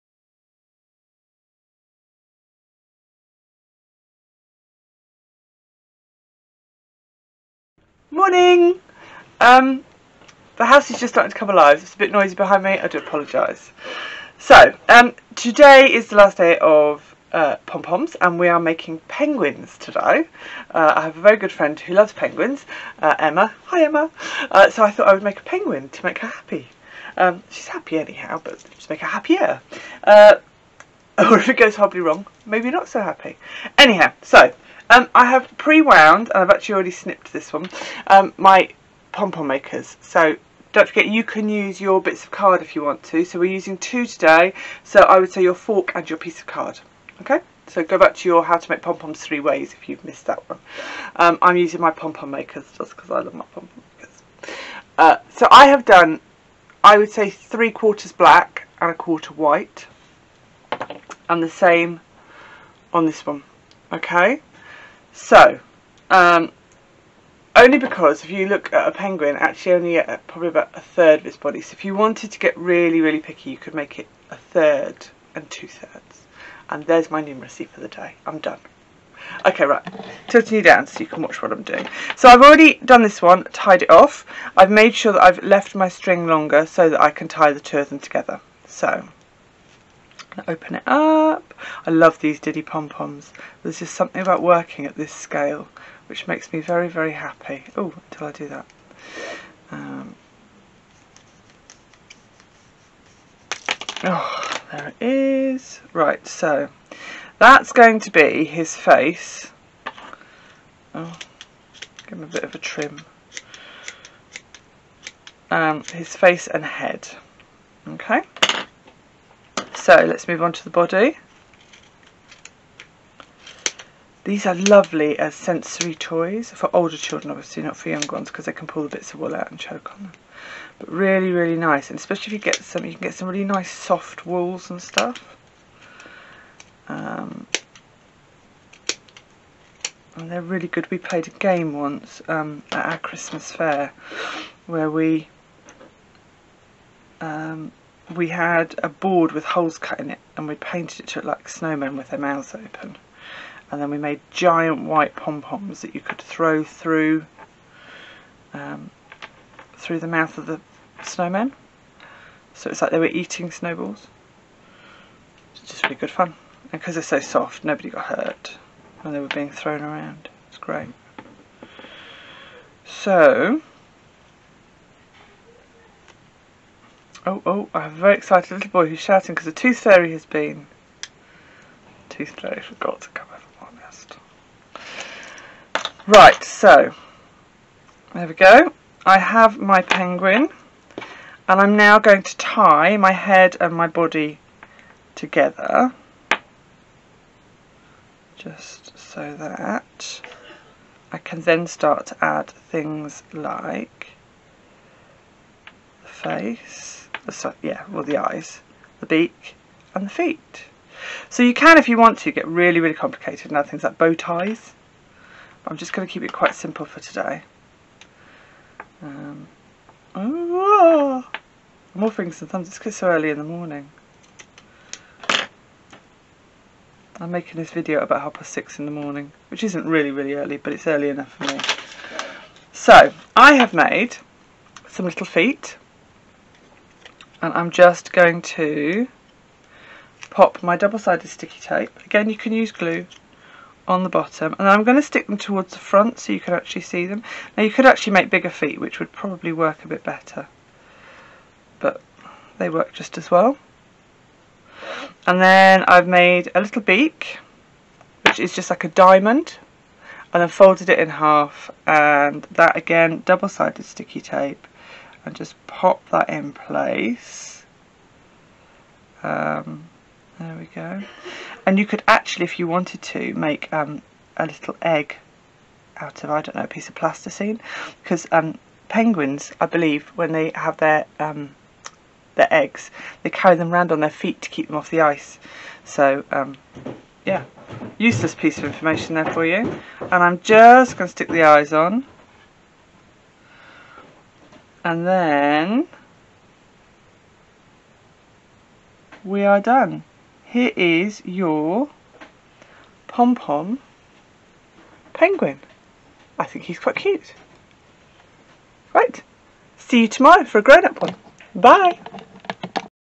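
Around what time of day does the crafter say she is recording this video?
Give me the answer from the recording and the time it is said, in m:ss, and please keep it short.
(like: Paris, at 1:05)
6:30 in the morning, at 3:48.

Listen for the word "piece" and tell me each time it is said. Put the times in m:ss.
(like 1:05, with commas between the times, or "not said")
0:46, 4:36, 4:48.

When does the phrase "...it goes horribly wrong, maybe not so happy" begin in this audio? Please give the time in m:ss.
0:31.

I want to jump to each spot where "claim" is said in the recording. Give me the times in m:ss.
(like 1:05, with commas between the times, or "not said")
not said.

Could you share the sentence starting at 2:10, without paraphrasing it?
But really, really nice, and especially if you get some, you can get some really nice soft wools and stuff.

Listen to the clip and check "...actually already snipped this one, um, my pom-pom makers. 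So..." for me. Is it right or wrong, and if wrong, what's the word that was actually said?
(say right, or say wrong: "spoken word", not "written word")
right.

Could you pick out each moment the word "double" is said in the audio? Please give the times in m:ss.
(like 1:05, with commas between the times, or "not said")
4:00, 4:23.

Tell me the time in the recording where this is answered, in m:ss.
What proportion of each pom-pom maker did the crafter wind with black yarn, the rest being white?
0:57.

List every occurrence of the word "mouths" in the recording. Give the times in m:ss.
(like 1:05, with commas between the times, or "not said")
2:32, 2:40.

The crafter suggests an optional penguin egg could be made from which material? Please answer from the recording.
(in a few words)
plasticine.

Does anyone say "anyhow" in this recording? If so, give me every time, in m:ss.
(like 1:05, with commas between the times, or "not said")
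0:27, 0:33.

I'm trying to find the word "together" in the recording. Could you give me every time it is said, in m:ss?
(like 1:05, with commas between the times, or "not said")
1:27, 3:15.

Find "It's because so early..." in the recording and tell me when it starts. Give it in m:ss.
3:42.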